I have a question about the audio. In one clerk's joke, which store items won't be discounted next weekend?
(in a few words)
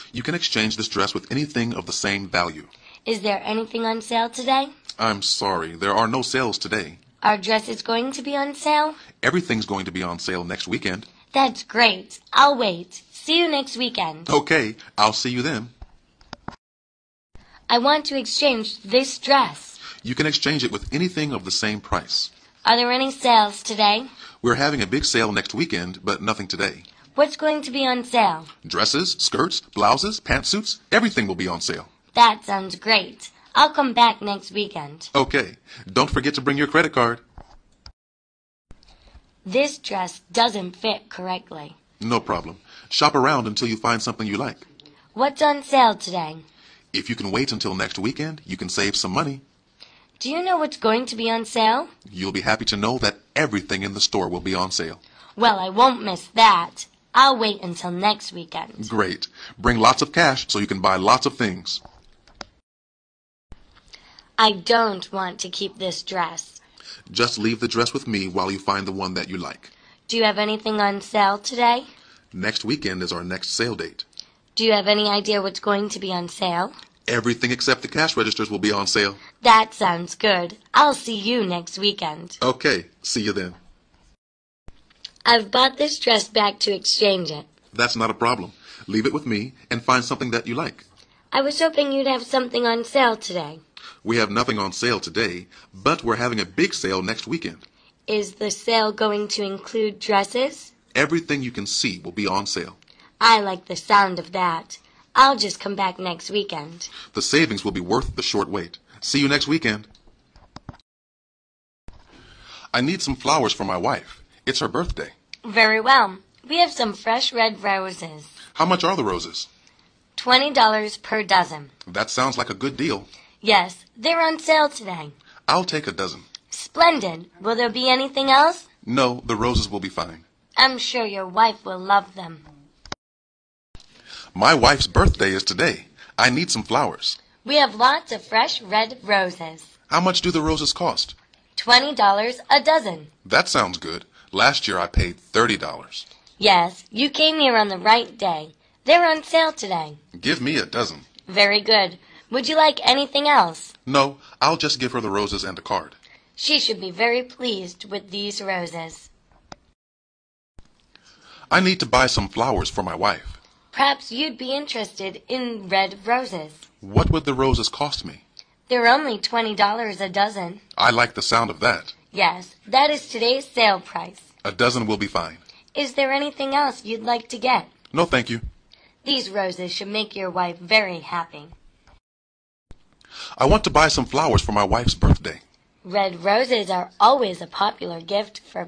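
cash registers.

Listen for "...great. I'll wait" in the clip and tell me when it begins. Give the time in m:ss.
0:11.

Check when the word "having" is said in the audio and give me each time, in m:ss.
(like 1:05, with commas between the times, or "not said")
0:24, 1:36.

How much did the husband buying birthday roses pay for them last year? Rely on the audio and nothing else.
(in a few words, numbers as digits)
$30.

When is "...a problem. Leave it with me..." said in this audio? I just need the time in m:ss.
1:28.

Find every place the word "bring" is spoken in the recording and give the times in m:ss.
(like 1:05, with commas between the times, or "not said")
0:36, 0:59.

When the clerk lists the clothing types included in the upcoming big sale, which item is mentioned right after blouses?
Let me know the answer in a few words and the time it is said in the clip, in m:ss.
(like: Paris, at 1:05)
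pantsuits, at 0:30.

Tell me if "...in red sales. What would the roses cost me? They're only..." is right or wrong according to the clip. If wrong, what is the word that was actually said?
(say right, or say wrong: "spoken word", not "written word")
wrong: "roses", not "sales".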